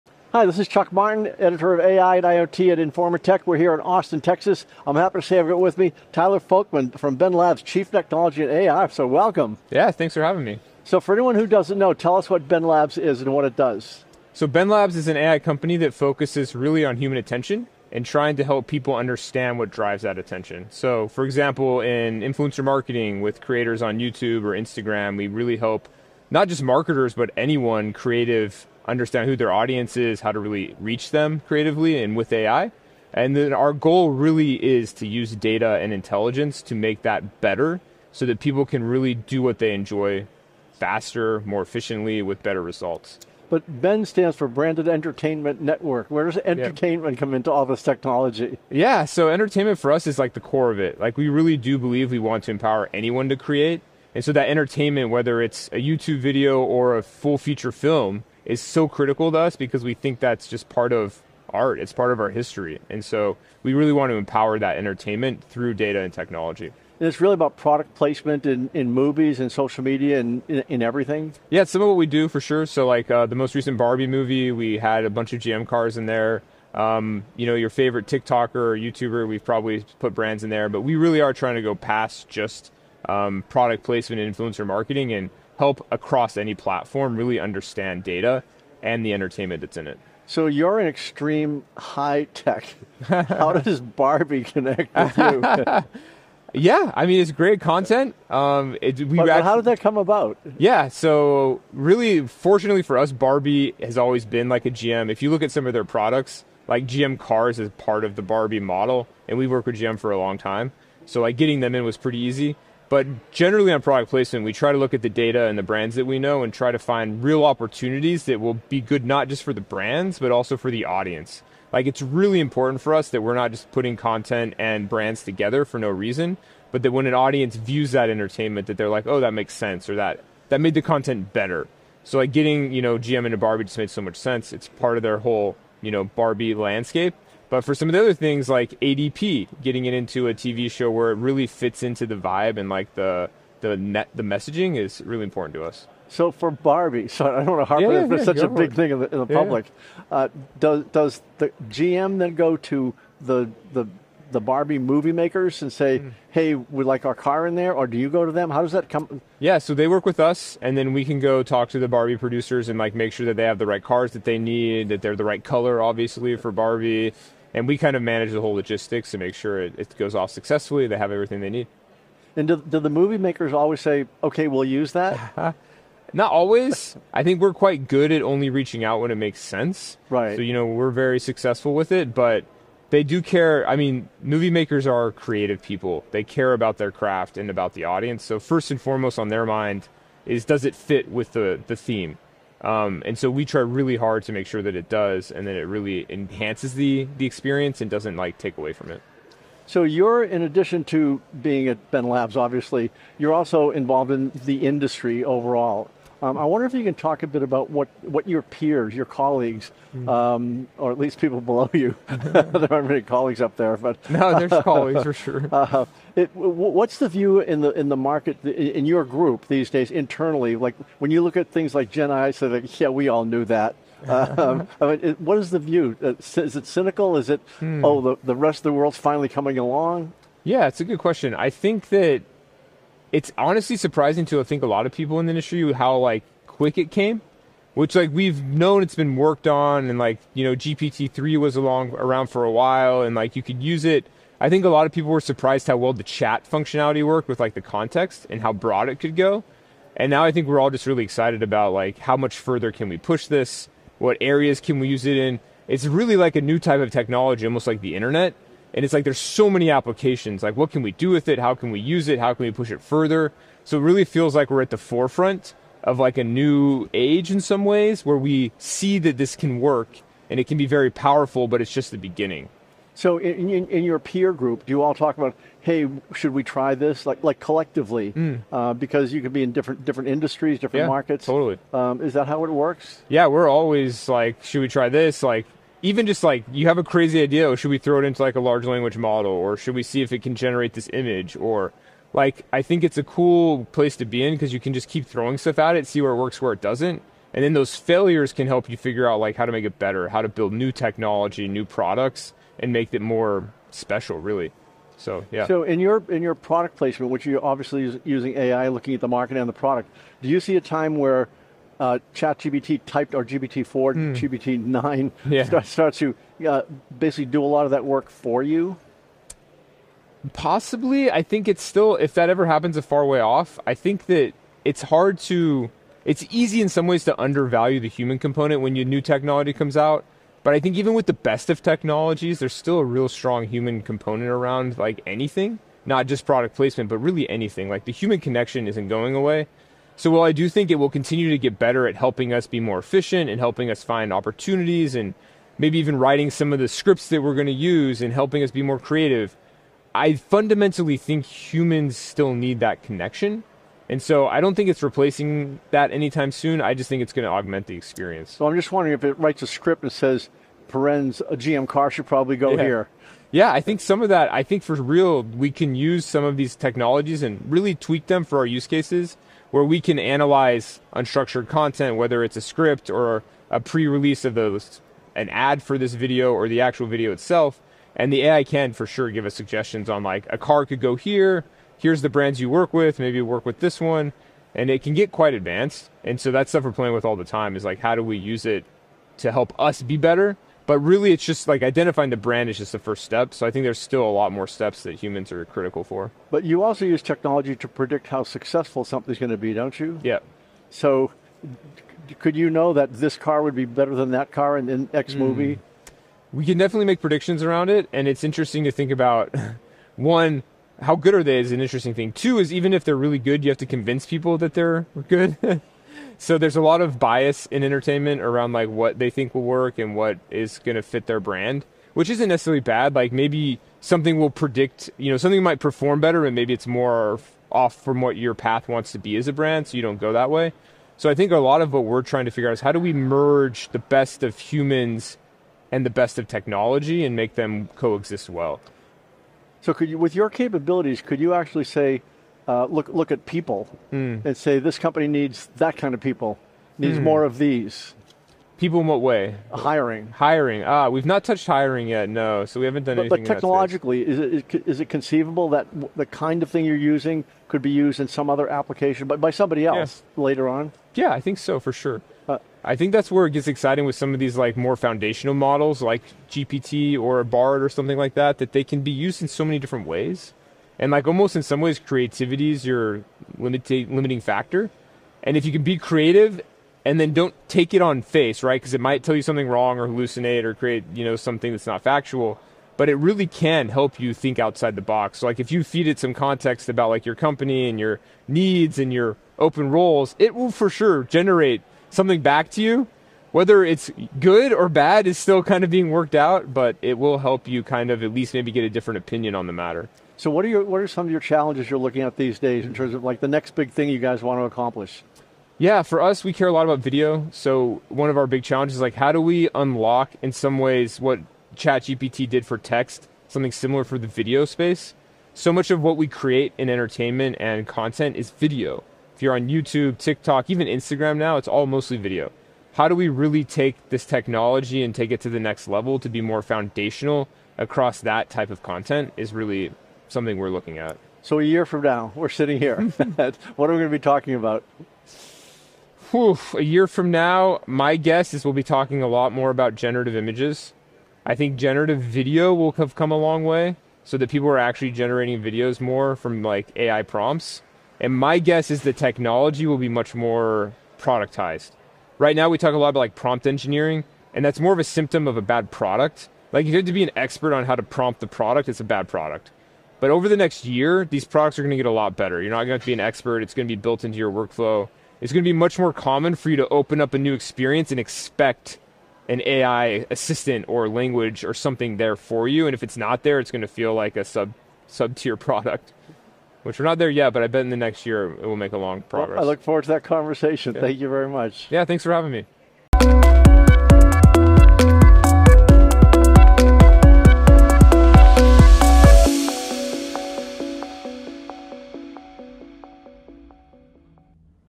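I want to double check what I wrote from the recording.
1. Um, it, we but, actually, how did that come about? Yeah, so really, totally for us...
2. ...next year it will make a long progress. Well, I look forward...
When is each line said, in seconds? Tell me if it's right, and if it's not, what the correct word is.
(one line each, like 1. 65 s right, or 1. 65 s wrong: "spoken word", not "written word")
1. 98 s wrong: "fortunately", not "totally"
2. 577 s right.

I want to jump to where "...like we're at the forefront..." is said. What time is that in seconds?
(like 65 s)
264 s.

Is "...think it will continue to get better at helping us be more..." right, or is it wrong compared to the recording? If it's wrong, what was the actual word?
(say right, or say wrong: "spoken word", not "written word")
right.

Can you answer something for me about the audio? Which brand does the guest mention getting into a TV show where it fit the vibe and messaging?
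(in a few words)
ADP.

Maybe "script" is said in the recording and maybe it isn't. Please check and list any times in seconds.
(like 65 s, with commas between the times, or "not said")
346 s, 359 s, 372 s.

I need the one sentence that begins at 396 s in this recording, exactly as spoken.
But you also use technology to predict how successful something's going to be, don't you?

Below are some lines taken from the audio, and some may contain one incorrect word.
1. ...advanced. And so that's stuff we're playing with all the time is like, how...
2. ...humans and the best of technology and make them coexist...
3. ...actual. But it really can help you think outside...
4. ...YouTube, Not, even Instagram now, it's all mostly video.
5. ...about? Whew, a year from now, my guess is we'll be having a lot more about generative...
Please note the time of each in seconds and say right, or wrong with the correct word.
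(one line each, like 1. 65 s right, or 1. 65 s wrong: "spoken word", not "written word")
1. 385 s right
2. 434 s right
3. 481 s wrong: "factual", not "actual"
4. 519 s wrong: "TikTok", not "Not"
5. 534 s wrong: "talking", not "having".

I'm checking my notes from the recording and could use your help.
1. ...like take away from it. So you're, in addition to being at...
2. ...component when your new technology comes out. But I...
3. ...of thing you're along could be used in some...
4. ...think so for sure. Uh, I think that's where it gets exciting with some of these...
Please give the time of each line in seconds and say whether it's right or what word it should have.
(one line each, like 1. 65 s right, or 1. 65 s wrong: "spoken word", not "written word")
1. 198 s right
2. 328 s right
3. 456 s wrong: "using", not "along"
4. 461 s right.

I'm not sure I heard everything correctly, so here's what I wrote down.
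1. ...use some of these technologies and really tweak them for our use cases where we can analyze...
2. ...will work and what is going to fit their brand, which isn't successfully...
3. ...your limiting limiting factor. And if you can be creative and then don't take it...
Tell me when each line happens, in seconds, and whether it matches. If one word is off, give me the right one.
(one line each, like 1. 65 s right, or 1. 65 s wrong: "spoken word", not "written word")
1. 365 s right
2. 419 s wrong: "necessarily", not "successfully"
3. 472 s right.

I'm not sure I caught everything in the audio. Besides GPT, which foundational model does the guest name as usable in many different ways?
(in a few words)
Bard.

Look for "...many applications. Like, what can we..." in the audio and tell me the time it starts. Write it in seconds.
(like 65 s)
259 s.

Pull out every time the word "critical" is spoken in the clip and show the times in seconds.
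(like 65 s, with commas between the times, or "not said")
58 s, 395 s.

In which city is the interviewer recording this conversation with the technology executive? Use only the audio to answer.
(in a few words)
Austin, Texas.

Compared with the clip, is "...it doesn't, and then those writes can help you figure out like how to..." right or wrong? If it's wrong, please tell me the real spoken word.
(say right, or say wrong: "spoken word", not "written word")
wrong: "failures", not "writes".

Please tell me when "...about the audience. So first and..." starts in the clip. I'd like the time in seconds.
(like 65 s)
187 s.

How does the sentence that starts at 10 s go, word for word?
So for anyone who doesn't know, tell us what Ben Labs is and what it does.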